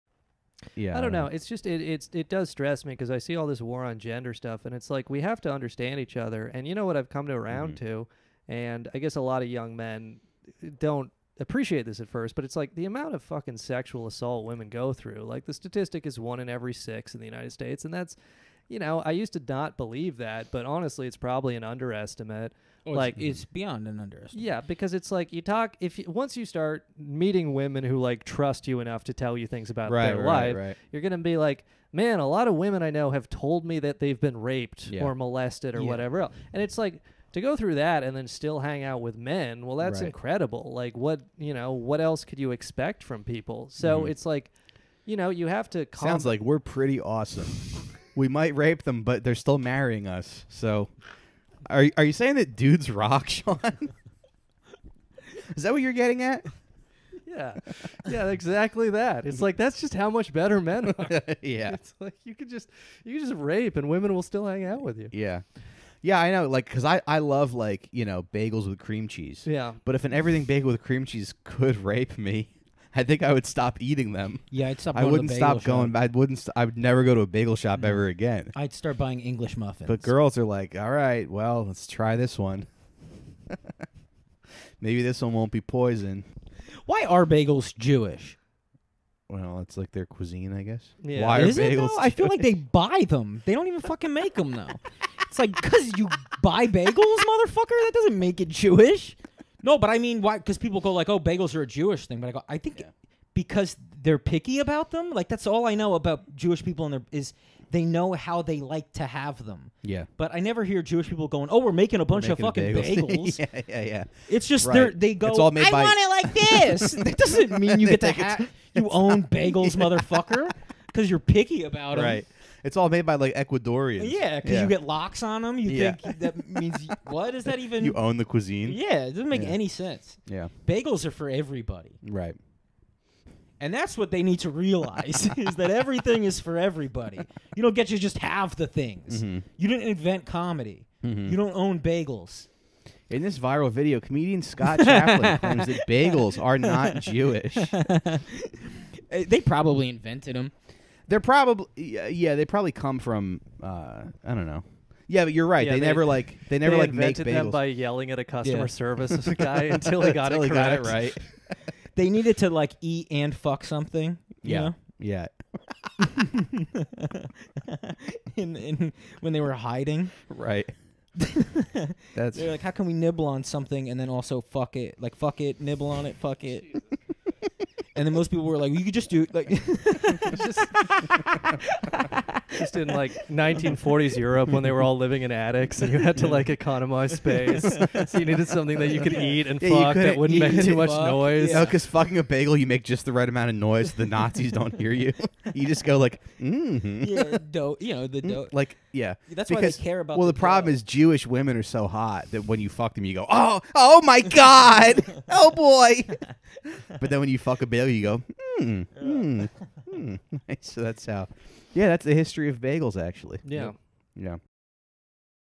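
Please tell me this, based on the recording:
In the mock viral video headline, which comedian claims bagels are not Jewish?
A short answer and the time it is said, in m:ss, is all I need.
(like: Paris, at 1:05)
Scott Chaplin, at 2:24.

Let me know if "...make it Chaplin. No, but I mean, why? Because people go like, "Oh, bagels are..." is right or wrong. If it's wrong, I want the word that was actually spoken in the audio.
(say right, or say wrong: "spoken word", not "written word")
wrong: "Jewish", not "Chaplin".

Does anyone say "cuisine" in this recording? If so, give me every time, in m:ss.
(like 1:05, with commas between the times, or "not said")
1:30, 2:08.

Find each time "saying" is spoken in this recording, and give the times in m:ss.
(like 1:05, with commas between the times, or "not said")
0:52.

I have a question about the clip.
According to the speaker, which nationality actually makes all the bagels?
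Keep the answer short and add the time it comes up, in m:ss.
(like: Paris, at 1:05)
Ecuadorians, at 2:03.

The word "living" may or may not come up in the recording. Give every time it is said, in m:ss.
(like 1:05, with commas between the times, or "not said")
3:04.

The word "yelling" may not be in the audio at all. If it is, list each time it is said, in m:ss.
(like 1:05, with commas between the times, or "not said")
2:37.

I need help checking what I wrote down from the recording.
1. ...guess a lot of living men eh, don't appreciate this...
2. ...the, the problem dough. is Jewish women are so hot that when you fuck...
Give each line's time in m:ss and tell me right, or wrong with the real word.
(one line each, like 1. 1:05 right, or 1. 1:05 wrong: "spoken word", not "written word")
1. 0:08 wrong: "young", not "living"
2. 3:20 right.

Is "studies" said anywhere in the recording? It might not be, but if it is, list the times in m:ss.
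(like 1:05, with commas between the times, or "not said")
not said.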